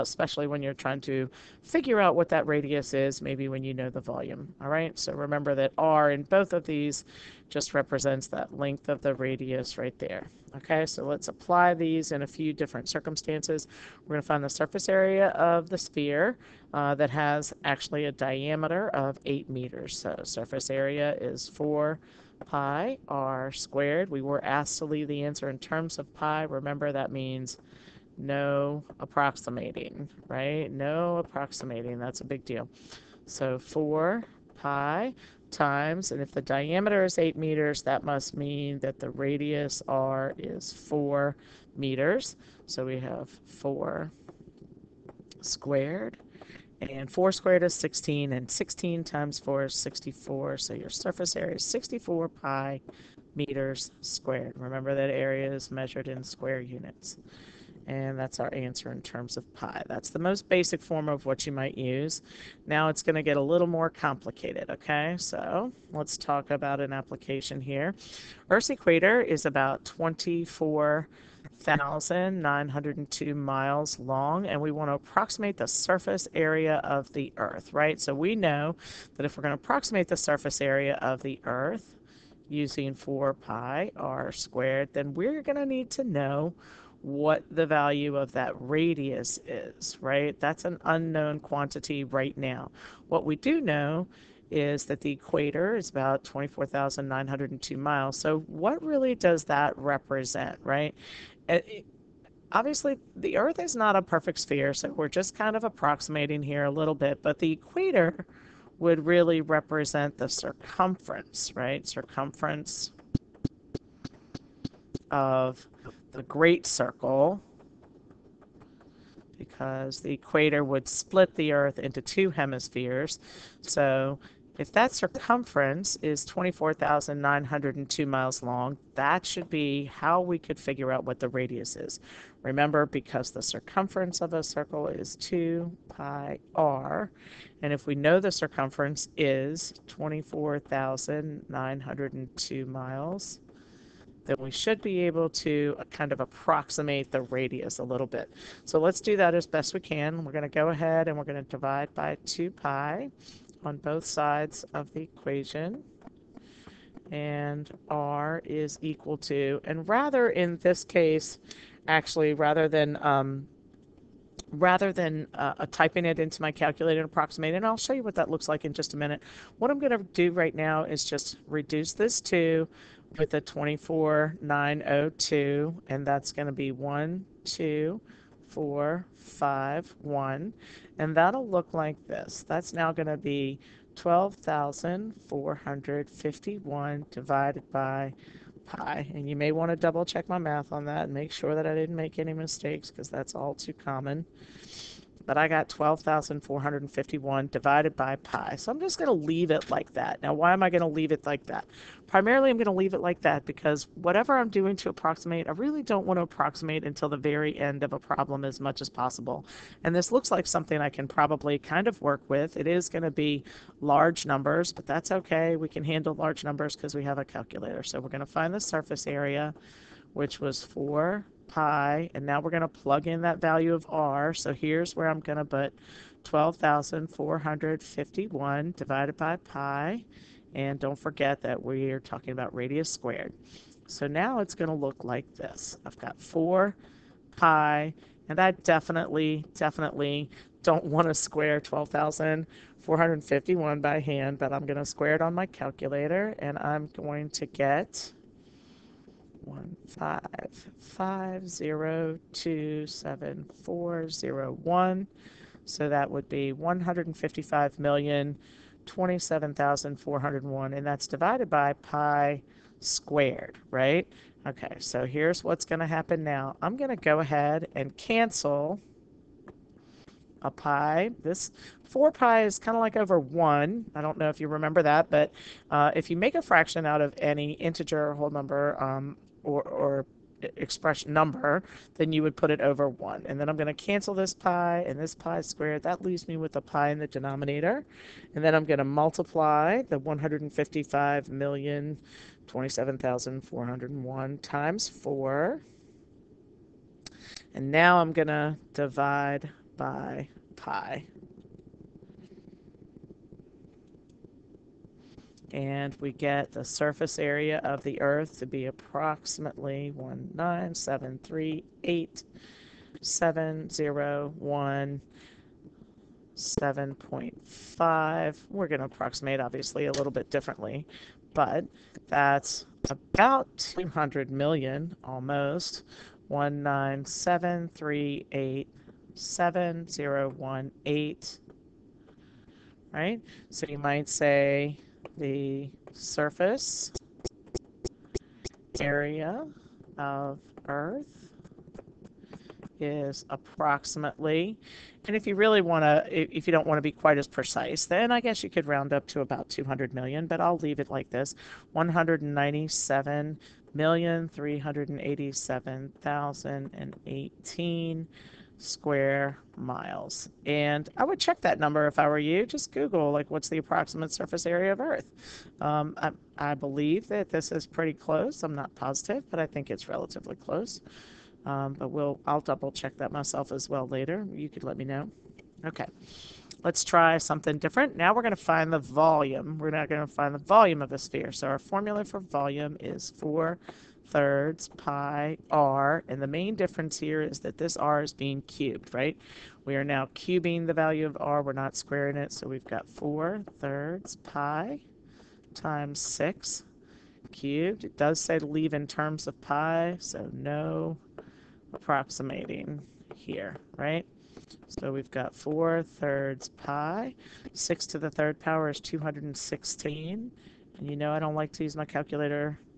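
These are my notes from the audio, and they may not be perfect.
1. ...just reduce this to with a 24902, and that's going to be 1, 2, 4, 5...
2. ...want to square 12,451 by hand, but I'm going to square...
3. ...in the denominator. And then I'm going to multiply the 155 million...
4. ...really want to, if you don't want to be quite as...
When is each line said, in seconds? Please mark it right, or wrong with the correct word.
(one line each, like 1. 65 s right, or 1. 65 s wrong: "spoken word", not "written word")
1. 171 s right
2. 240 s right
3. 286 s right
4. 345 s right.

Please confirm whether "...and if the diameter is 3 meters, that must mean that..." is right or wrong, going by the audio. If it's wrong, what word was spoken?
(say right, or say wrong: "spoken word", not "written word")
wrong: "8", not "3".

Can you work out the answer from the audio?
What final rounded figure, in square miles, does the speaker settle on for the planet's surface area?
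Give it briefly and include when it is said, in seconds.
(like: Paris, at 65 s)
197,387,018, at 351 s.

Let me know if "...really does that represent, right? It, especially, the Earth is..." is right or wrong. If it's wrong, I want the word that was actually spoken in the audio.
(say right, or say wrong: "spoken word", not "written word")
wrong: "obviously", not "especially".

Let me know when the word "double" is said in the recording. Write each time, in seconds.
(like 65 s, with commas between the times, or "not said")
189 s, 372 s.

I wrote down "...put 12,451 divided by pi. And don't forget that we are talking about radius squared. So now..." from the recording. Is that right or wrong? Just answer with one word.
right.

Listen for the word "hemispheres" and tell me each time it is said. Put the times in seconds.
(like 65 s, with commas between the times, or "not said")
122 s.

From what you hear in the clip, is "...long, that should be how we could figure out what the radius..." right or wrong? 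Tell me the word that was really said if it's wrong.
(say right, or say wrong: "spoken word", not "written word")
right.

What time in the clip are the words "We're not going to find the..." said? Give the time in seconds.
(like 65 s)
379 s.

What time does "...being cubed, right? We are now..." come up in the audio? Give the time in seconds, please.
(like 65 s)
388 s.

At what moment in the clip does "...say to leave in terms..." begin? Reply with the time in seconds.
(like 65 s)
398 s.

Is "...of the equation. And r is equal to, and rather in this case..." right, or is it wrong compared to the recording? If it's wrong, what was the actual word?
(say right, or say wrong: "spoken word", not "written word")
right.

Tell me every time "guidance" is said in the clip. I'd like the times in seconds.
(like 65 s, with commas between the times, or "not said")
not said.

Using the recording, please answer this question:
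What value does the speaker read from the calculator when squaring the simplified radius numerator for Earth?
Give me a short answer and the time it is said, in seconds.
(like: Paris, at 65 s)
155,027,401, at 249 s.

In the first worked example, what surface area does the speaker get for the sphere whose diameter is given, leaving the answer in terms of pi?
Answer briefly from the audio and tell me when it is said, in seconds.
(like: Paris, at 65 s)
64 pi meters squared, at 51 s.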